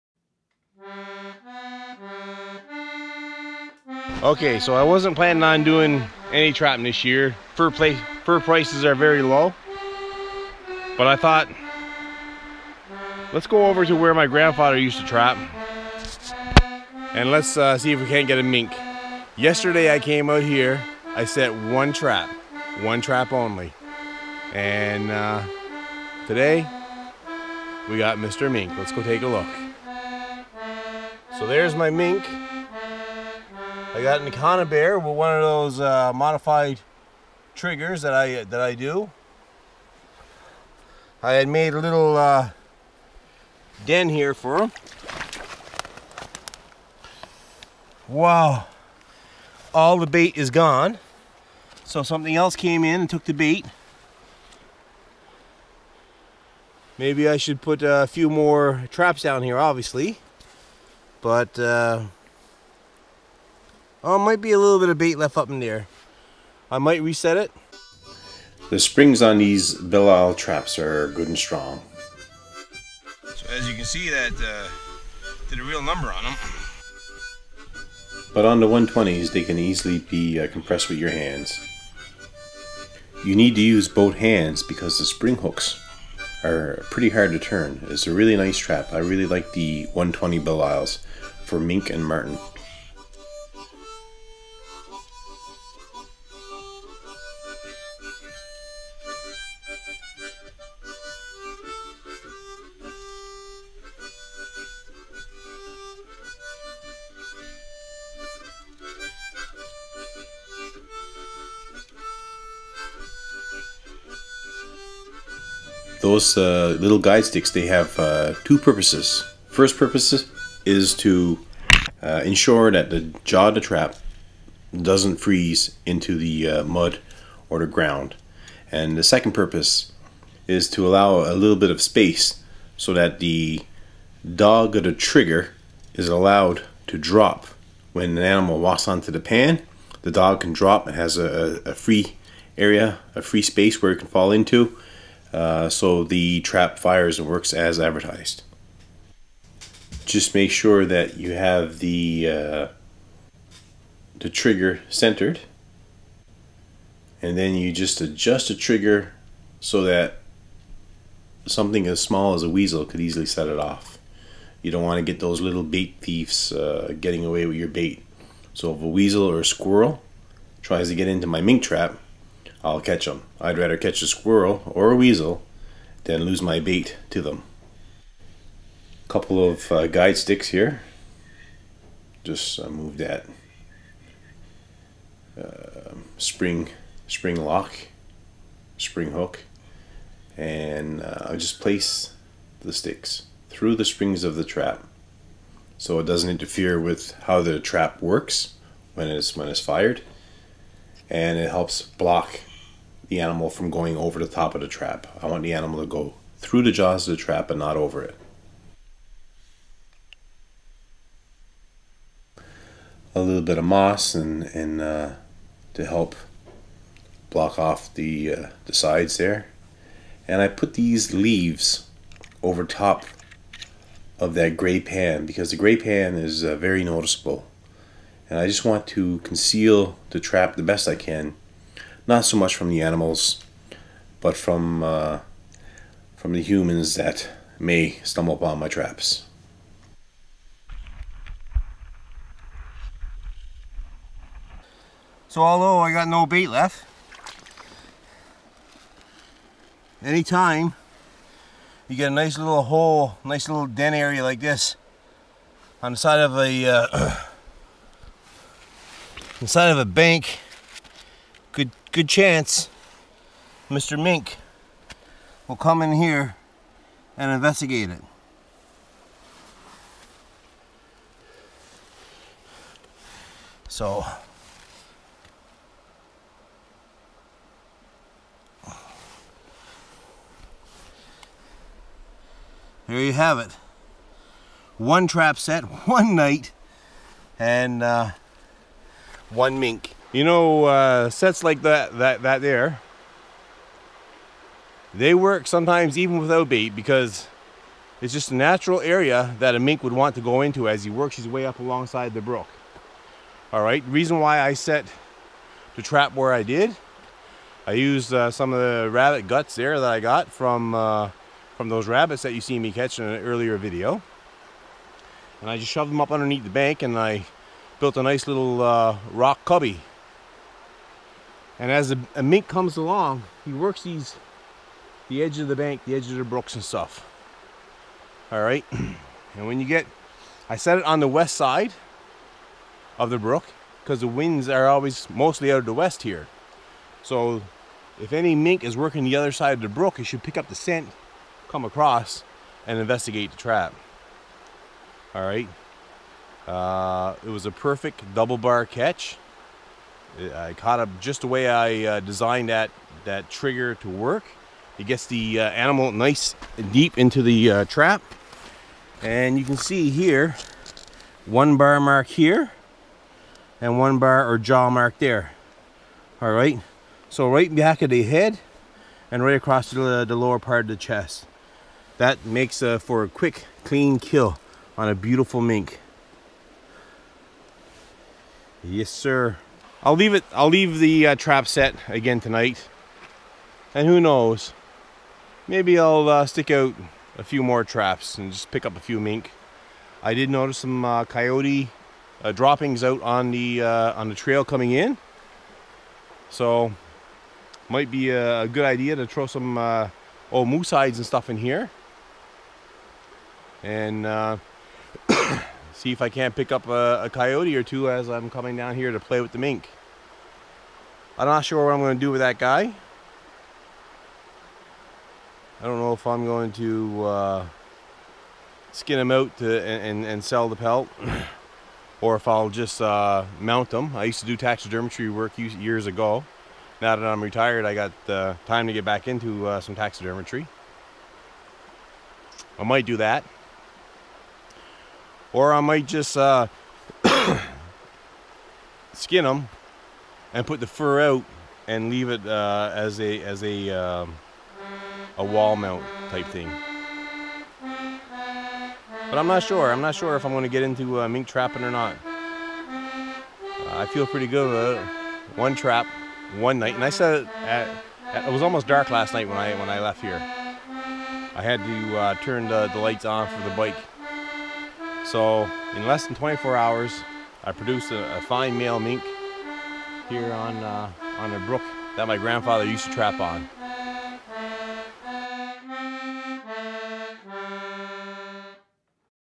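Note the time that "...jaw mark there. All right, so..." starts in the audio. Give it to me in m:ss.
6:04.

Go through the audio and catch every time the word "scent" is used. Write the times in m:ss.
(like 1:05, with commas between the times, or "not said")
5:40.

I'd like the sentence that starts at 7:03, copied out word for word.
I used to do taxidermy work years ago.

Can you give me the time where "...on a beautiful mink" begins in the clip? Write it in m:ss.
6:14.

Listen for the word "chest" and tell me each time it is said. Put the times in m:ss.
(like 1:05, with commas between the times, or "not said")
6:10.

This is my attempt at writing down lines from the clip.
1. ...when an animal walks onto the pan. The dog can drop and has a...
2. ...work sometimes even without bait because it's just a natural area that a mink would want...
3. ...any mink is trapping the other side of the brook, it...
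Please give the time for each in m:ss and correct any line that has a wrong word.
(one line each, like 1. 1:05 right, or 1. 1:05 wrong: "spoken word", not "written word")
1. 2:17 right
2. 4:55 right
3. 5:38 wrong: "working", not "trapping".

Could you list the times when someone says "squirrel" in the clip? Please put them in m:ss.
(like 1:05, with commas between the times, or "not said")
2:49, 2:54.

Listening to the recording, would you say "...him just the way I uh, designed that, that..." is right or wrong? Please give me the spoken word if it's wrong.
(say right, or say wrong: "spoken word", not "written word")
right.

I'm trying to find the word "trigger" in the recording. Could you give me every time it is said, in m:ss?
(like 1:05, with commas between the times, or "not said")
0:37, 2:14, 2:34, 2:38, 5:53.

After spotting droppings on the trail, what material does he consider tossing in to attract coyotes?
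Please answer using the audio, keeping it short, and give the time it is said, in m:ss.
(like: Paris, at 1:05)
old moose hides, at 6:40.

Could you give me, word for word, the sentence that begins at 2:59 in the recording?
Couple of uh, guide sticks here.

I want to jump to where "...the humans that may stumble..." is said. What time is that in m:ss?
3:56.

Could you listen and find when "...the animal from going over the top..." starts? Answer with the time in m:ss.
3:23.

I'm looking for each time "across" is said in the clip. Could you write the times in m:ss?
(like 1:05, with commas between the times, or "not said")
5:41, 6:09.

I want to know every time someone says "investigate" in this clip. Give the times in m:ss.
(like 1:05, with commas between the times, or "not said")
4:27, 5:42.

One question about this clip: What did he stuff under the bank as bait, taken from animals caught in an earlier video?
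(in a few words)
rabbit guts.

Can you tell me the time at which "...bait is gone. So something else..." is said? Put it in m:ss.
0:50.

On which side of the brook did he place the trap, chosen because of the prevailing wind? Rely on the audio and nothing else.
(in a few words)
west side.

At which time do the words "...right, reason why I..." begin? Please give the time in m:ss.
5:03.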